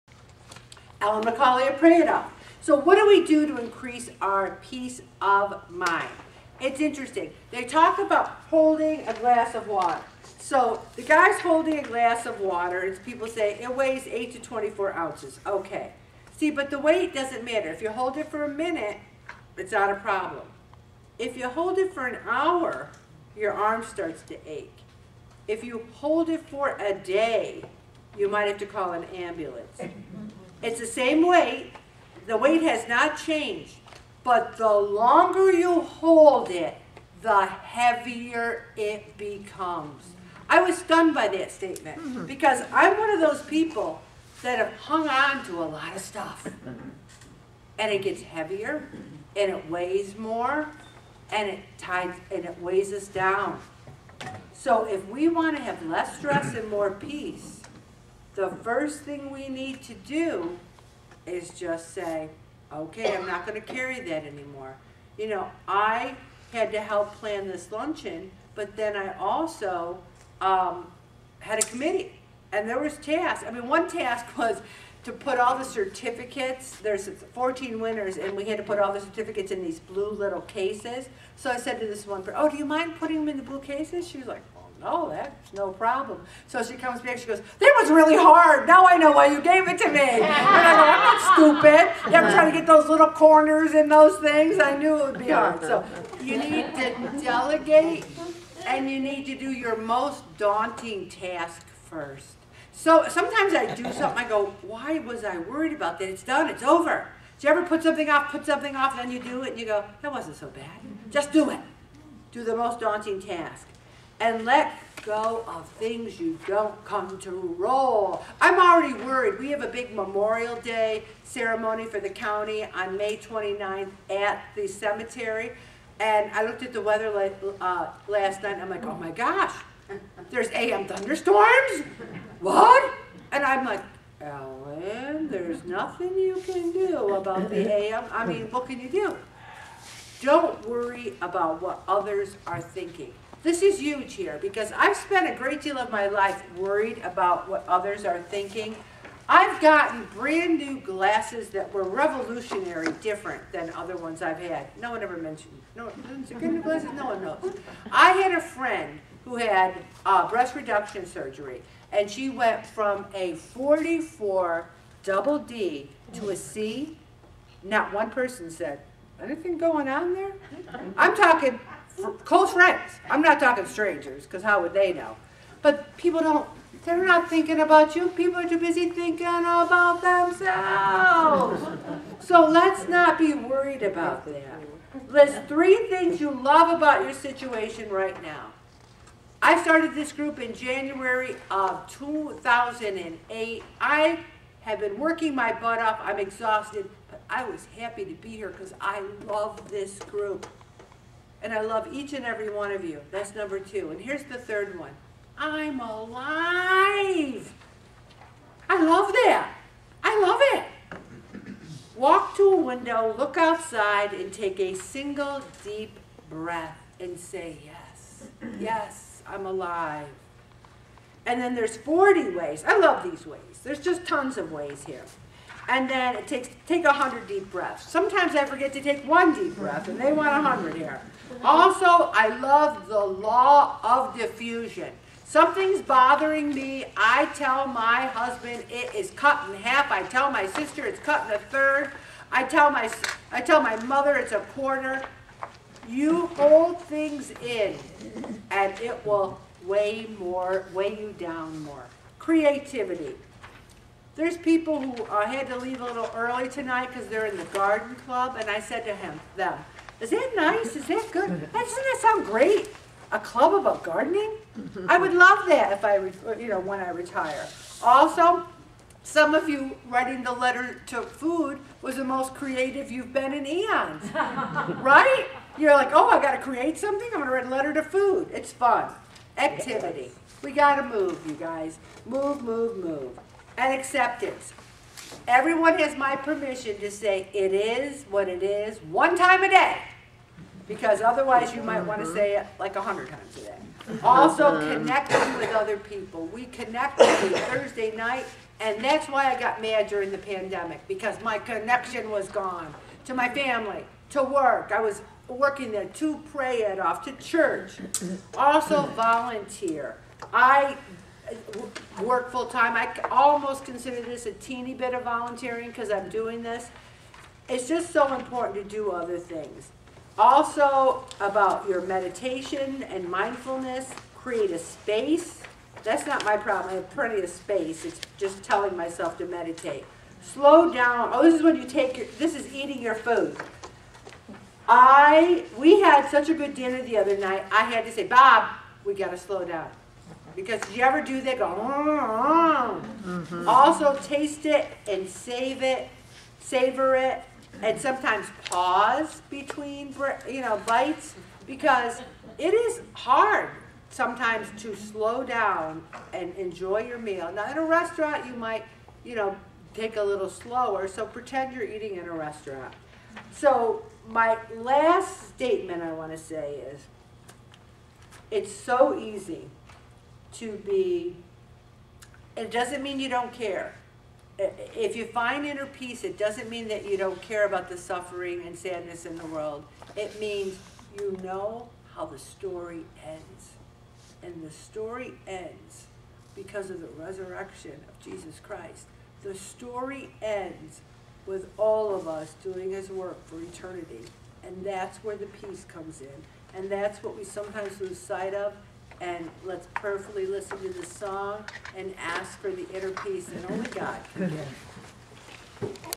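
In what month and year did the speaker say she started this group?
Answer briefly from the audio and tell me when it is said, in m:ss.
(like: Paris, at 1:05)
January 2008, at 3:10.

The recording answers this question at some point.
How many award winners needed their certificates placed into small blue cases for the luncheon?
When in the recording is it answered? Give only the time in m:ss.
1:17.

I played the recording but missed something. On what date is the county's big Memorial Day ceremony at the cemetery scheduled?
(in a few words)
May 29.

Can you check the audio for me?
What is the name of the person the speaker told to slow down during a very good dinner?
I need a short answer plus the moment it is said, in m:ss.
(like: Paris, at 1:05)
Bob, at 5:38.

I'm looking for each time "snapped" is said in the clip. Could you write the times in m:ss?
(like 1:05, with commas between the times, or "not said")
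not said.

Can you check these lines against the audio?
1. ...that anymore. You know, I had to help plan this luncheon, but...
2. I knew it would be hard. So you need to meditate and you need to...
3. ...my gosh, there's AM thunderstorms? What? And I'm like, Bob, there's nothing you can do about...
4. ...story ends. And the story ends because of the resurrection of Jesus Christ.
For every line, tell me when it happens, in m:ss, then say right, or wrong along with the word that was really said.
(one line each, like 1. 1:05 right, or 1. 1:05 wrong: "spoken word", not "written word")
1. 1:04 right
2. 1:34 wrong: "delegate", not "meditate"
3. 2:08 wrong: "Ellen", not "Bob"
4. 6:22 right.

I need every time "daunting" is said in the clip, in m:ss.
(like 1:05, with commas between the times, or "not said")
1:40, 1:52.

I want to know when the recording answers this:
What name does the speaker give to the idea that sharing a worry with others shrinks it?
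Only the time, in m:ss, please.
3:52.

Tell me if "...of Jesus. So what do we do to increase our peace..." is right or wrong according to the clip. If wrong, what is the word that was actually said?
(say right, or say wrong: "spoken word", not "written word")
wrong: "Prado", not "Jesus".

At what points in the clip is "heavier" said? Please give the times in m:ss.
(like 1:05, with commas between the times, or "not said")
0:37, 0:48.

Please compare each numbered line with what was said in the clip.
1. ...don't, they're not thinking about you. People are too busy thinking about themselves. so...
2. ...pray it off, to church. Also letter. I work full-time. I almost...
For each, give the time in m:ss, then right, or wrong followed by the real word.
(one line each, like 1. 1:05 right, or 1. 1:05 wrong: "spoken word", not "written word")
1. 2:56 right
2. 5:06 wrong: "volunteer", not "letter".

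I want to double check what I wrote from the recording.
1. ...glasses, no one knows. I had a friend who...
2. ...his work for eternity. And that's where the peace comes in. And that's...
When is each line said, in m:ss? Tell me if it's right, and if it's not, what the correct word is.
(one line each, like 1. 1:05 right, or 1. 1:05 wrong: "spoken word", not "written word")
1. 2:36 right
2. 6:32 right.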